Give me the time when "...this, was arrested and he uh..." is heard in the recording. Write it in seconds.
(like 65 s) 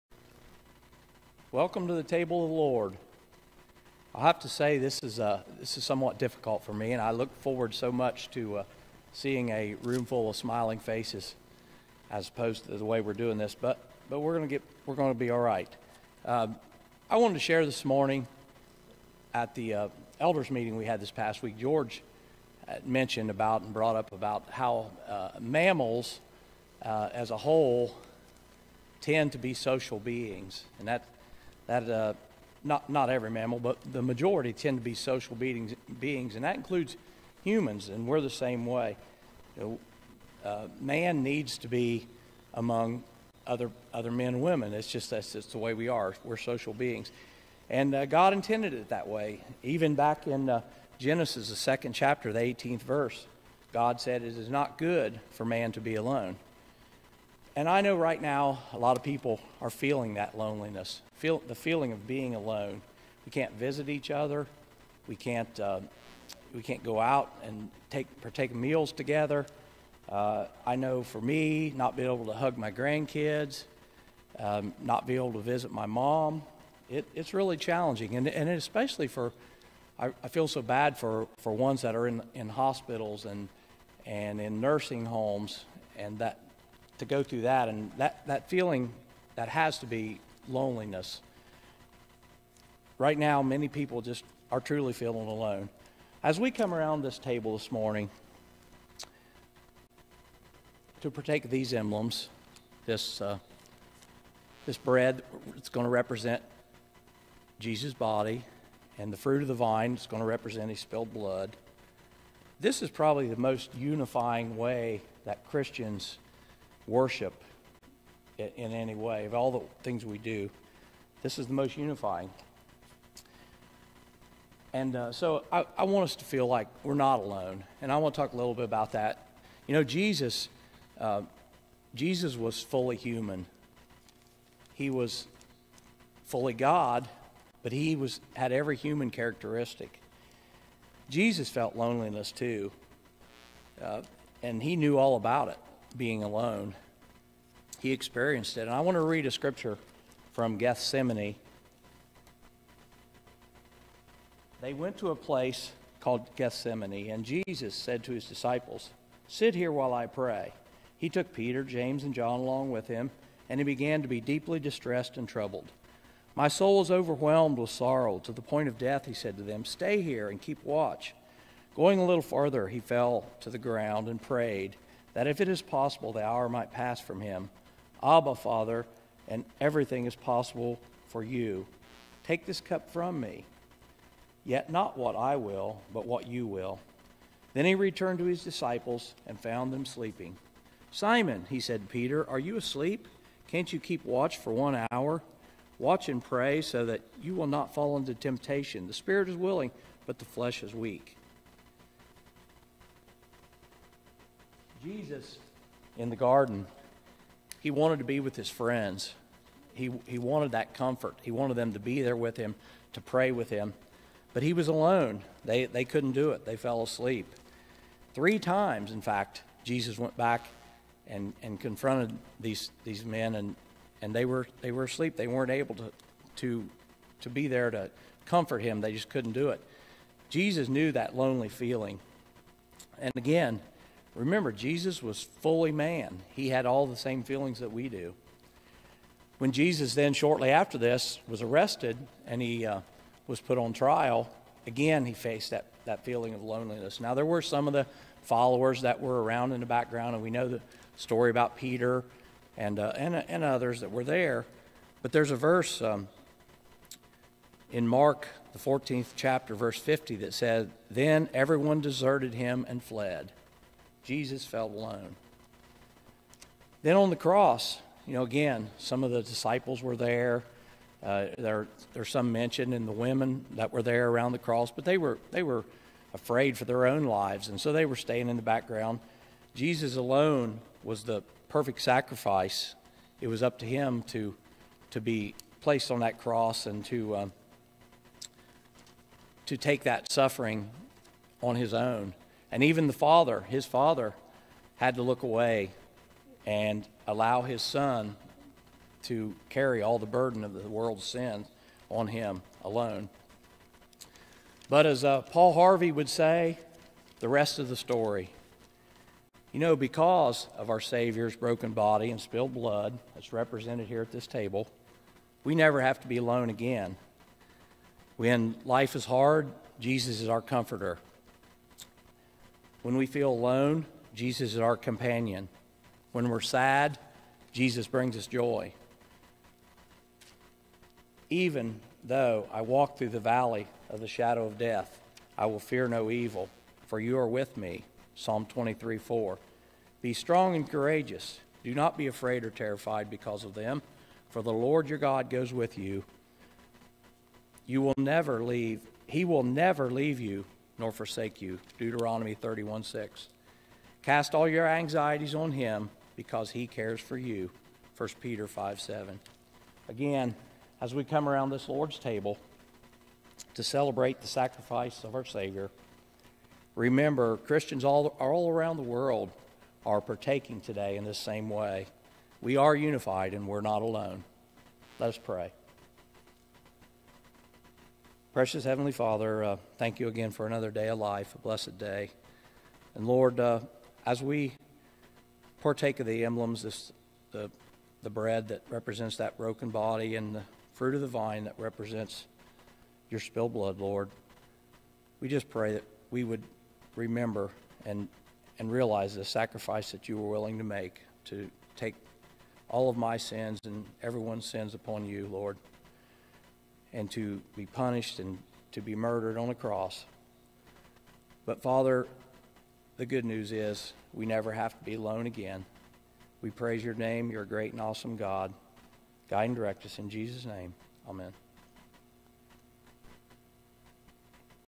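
240 s.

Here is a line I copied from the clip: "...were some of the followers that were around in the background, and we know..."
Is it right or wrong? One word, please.
right.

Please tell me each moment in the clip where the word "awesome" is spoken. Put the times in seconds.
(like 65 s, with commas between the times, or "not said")
417 s.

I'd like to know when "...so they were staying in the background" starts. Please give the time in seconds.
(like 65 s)
277 s.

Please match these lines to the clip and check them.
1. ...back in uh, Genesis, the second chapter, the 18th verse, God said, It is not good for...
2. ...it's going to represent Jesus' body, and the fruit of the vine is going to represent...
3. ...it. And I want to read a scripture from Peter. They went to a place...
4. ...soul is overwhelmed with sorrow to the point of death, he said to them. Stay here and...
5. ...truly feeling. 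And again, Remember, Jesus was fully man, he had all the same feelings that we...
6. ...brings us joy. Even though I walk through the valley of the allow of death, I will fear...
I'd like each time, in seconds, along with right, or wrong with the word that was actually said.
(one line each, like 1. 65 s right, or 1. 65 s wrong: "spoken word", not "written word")
1. 49 s right
2. 105 s right
3. 148 s wrong: "Gethsemane", not "Peter"
4. 166 s right
5. 231 s wrong: "lonely", not "truly"
6. 327 s wrong: "shadow", not "allow".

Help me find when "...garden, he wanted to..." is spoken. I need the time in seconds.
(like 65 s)
206 s.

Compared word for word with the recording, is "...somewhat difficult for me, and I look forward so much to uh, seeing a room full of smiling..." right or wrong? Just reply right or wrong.
right.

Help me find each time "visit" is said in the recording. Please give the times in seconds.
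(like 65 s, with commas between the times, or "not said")
63 s, 75 s.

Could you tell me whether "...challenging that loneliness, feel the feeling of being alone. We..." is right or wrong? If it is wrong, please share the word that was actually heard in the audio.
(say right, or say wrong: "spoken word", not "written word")
wrong: "feeling", not "challenging".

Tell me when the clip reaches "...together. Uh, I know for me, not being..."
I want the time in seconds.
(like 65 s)
68 s.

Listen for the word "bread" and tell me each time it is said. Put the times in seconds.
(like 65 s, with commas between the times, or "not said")
104 s, 388 s.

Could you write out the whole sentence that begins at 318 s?
When life is hard, Jesus is our comforter.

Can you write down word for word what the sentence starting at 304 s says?
But as uh, Paul Harvey would say, the rest of the story.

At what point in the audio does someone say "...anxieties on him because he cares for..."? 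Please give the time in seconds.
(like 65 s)
354 s.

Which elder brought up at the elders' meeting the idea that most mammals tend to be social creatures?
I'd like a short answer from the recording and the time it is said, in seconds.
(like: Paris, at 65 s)
George, at 21 s.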